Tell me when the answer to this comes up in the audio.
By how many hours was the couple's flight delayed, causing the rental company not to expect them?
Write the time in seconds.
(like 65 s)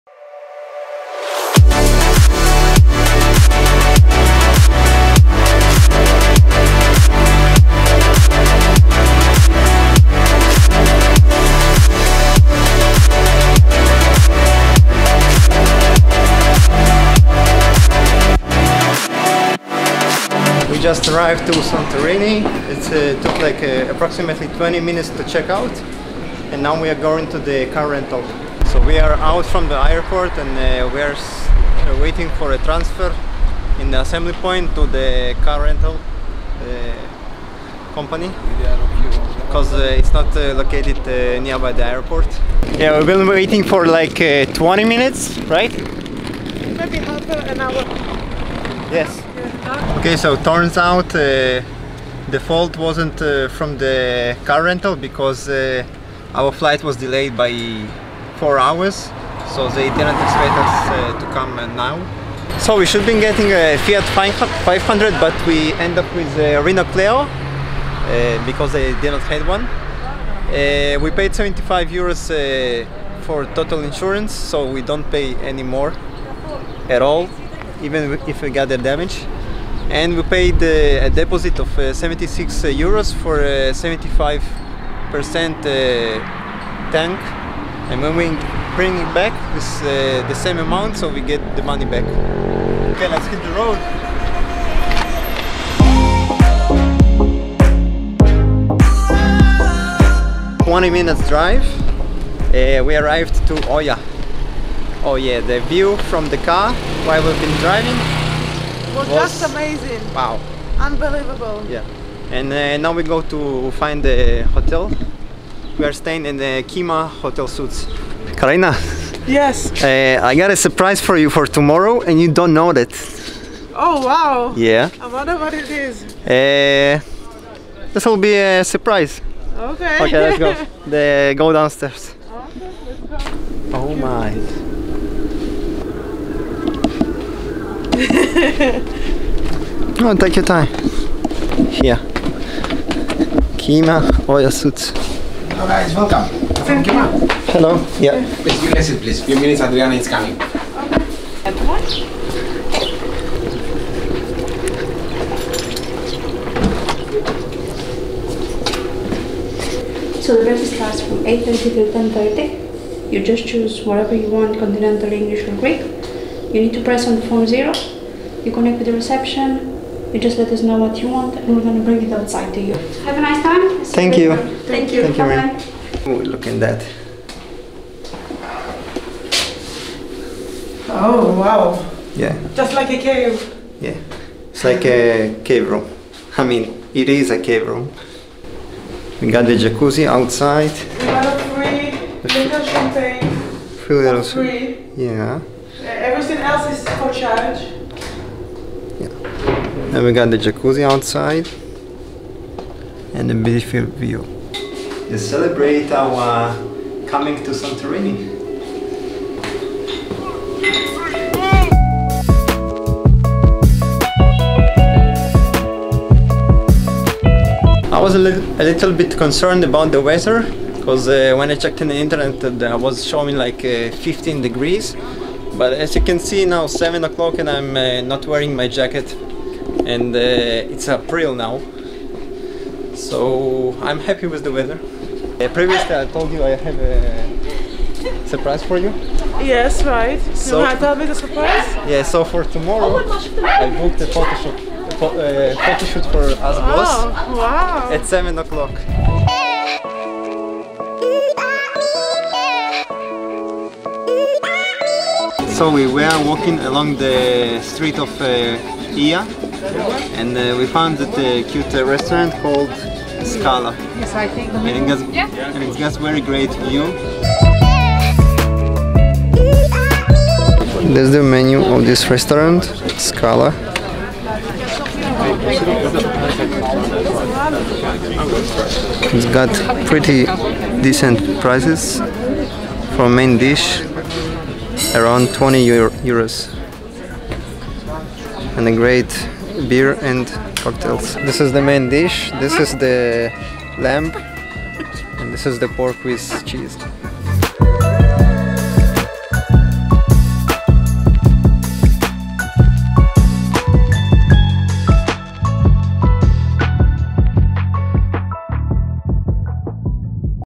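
58 s.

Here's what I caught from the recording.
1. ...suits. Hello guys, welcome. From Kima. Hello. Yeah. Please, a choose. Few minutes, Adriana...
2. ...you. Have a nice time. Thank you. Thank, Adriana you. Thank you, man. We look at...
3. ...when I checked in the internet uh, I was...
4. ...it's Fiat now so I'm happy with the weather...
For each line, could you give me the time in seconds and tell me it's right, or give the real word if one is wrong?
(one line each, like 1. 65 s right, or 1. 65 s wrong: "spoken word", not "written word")
1. 144 s wrong: "please", not "choose"
2. 172 s wrong: "Thank", not "Adriana"
3. 221 s right
4. 230 s wrong: "April", not "Fiat".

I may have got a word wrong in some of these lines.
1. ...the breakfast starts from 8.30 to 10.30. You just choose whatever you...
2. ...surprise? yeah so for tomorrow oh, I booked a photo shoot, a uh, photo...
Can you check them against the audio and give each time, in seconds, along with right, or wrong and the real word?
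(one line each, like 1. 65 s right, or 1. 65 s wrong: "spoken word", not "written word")
1. 160 s right
2. 241 s right.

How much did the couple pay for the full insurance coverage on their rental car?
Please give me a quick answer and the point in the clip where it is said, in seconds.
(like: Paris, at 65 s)
75 euros, at 71 s.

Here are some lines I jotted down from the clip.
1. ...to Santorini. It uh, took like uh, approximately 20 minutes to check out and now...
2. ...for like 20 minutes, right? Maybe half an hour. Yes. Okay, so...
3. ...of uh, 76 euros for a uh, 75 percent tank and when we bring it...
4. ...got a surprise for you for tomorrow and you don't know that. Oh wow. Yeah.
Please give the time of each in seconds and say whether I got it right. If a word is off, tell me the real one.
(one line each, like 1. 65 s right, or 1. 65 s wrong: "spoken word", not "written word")
1. 21 s right
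2. 43 s right
3. 81 s right
4. 120 s right.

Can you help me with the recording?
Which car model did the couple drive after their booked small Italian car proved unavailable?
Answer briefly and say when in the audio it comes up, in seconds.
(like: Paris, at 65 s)
Renault Clio, at 66 s.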